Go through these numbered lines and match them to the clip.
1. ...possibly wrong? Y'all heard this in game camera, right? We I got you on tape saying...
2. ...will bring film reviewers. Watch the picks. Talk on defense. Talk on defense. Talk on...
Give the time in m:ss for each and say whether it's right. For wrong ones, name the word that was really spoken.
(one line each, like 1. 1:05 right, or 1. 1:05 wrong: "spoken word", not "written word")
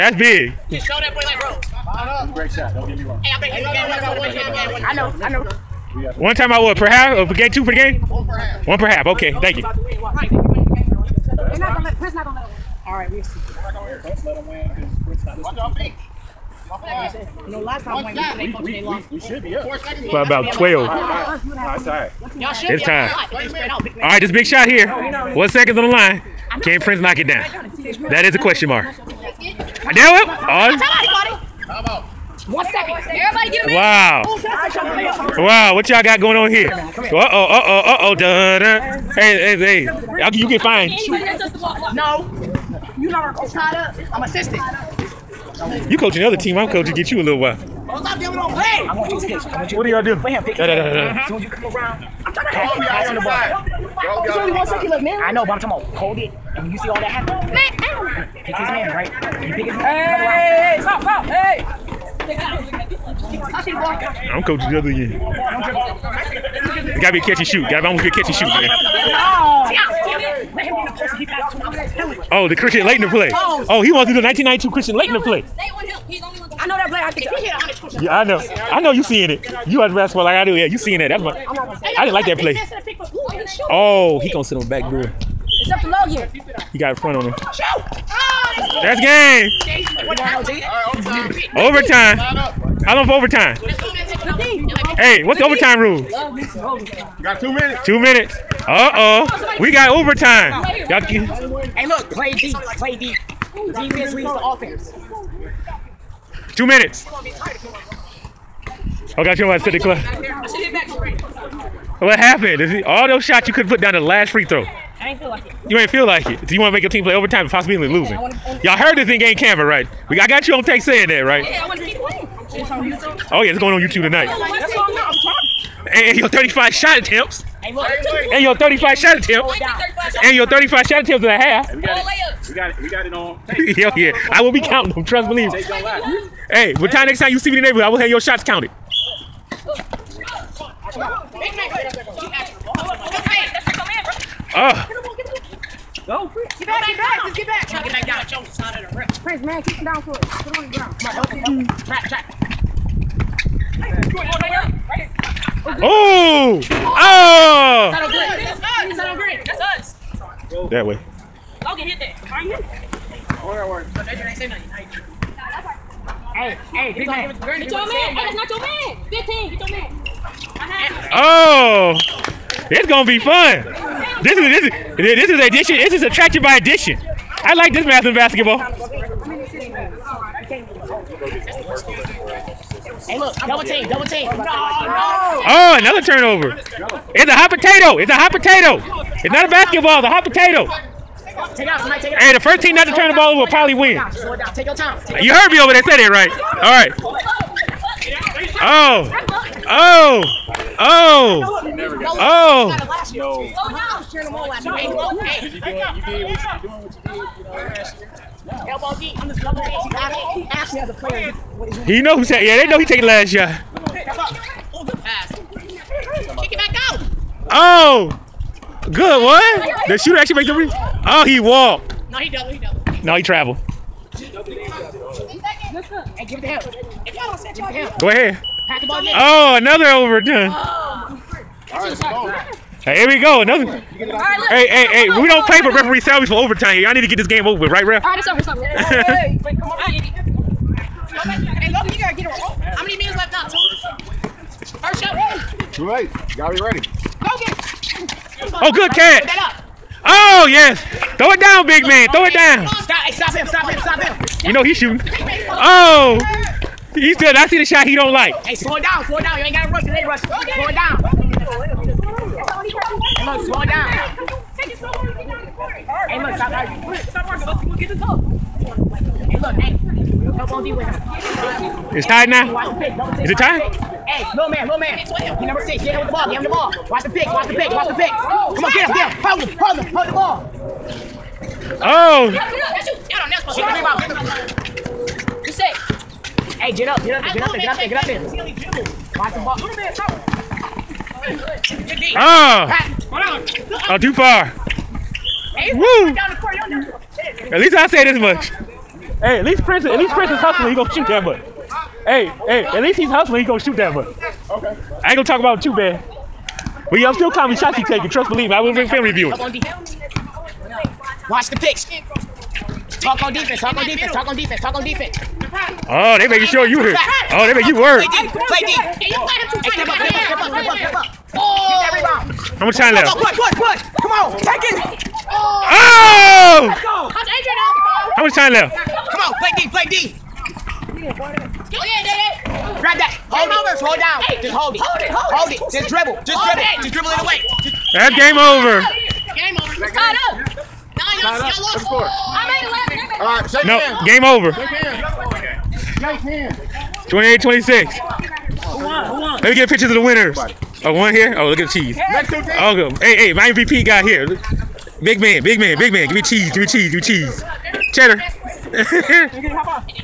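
1. 1:57 wrong: "losing", not "wrong"
2. 5:08 right.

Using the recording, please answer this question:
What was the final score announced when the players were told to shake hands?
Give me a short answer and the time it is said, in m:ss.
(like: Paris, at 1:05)
28-26, at 5:47.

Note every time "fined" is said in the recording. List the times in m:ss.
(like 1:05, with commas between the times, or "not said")
0:40.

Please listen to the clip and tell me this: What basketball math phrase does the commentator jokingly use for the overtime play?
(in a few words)
attraction by addition.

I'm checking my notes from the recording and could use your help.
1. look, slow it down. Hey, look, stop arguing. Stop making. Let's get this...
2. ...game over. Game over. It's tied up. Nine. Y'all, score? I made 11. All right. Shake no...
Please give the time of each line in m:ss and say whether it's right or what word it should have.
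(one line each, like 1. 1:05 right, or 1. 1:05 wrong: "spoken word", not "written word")
1. 4:23 wrong: "arguing", not "making"
2. 5:38 right.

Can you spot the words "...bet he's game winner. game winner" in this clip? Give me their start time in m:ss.
0:03.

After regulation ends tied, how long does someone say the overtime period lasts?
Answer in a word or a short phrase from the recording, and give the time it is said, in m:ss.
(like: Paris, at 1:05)
2 minutes, at 1:37.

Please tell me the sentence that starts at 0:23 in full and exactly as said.
a Big All right, this big shot here.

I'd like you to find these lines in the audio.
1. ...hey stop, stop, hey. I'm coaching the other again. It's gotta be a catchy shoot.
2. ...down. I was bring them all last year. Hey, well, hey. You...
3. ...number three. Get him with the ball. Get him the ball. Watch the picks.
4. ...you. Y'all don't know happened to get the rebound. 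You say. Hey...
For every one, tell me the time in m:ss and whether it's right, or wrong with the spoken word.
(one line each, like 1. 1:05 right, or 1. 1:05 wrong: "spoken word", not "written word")
1. 1:00 right
2. 3:23 wrong: "cheering", not "bring"
3. 4:35 wrong: "six", not "three"
4. 4:42 wrong: "supposed", not "happened".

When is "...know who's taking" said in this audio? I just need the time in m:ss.
3:31.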